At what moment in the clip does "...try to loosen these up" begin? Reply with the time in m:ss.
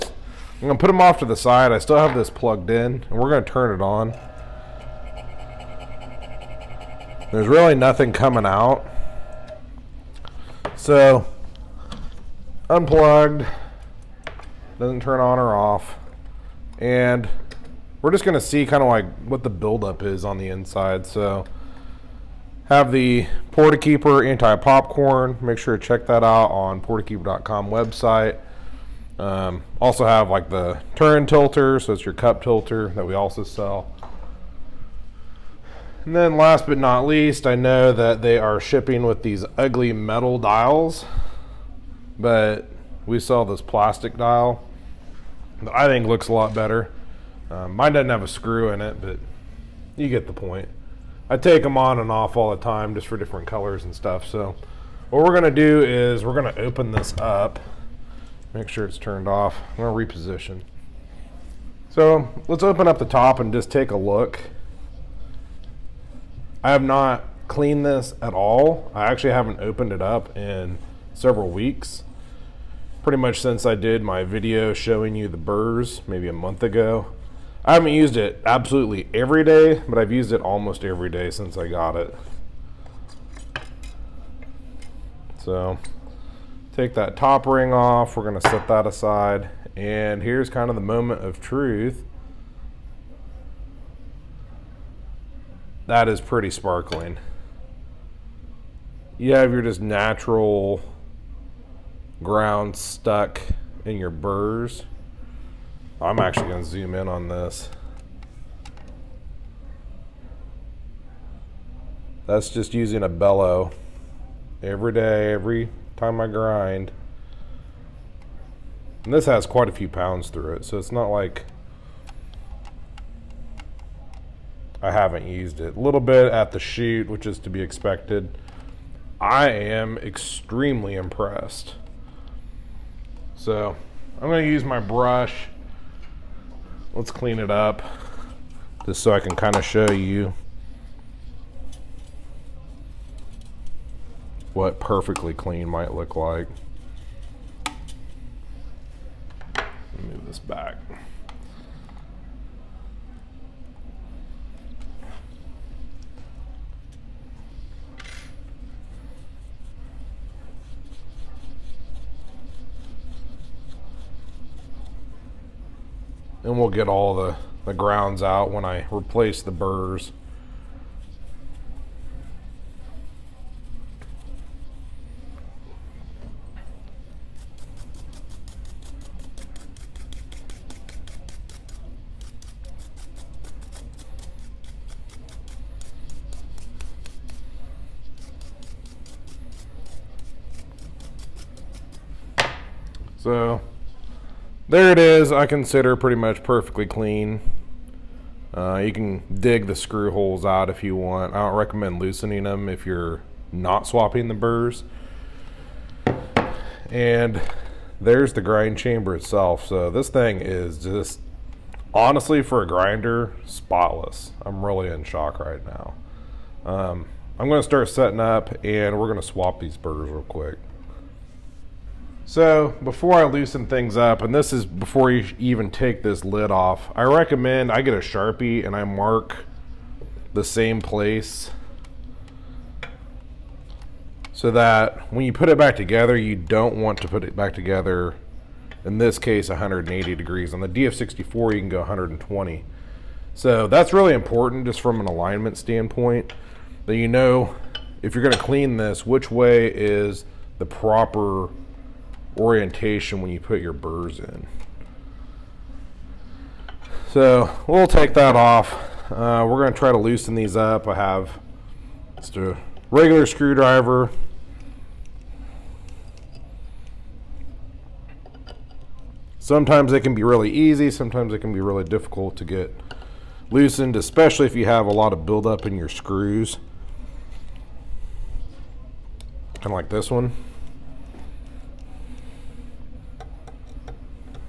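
4:19.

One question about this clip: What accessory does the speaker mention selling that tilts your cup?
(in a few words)
turn tilter.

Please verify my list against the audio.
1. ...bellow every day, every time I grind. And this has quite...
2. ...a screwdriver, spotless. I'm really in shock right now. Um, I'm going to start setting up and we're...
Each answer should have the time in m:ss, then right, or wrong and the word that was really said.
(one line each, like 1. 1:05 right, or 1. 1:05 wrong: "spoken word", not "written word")
1. 1:53 right
2. 3:32 wrong: "grinder", not "screwdriver".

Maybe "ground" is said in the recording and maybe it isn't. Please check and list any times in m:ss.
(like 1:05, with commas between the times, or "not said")
1:42, 2:47.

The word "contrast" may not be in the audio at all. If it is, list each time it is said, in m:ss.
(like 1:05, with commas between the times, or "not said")
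not said.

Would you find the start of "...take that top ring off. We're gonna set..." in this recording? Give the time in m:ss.
1:26.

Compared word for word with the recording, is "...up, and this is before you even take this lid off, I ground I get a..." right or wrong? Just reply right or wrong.
wrong.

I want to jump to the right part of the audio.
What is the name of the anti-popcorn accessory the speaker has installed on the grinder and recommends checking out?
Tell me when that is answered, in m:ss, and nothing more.
0:23.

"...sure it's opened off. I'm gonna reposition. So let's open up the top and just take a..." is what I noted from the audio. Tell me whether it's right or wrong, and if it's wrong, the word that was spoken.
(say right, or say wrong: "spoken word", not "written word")
wrong: "turned", not "opened".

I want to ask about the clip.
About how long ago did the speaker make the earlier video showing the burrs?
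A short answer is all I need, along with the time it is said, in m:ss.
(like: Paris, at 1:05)
a month ago, at 1:16.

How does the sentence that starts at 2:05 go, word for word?
A little bit at the chute, which is to be expected.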